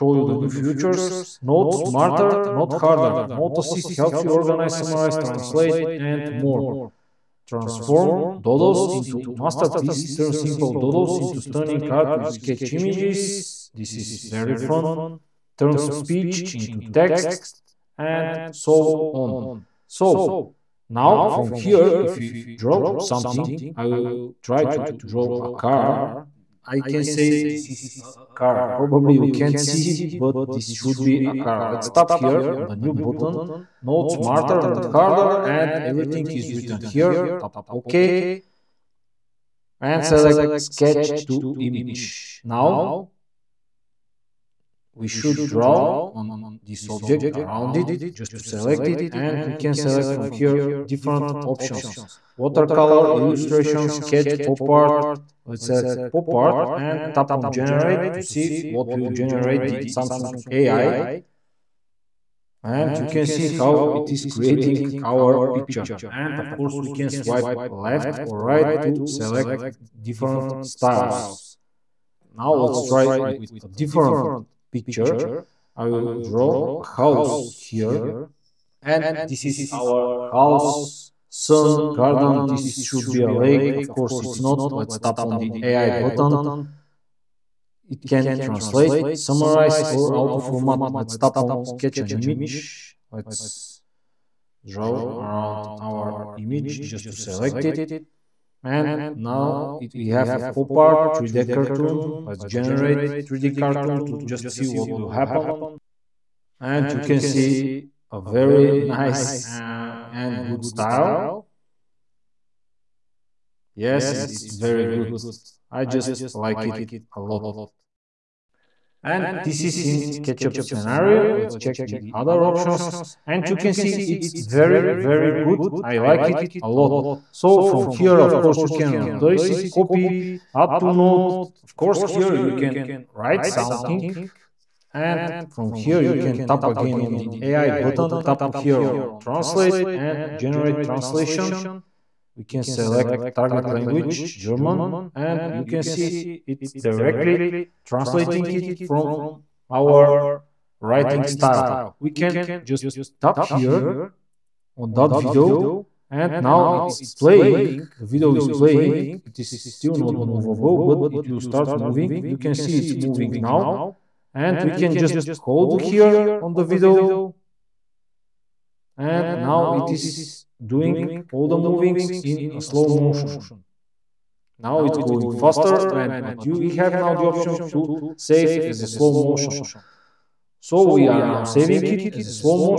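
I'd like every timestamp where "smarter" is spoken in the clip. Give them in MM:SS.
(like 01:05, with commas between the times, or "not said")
00:01, 00:34.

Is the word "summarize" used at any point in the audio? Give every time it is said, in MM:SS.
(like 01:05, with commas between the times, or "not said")
00:04, 01:29.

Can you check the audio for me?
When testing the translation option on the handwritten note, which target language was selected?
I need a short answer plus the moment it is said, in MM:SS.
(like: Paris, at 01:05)
German, at 02:24.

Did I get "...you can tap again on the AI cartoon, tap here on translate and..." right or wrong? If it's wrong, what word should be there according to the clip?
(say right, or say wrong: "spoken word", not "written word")
wrong: "button", not "cartoon".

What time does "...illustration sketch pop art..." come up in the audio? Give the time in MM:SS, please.
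00:53.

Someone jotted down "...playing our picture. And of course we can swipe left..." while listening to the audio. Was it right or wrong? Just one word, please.
wrong.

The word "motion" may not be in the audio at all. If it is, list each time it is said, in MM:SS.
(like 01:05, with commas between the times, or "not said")
02:52, 02:59.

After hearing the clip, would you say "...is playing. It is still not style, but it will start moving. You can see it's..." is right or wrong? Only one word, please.
wrong.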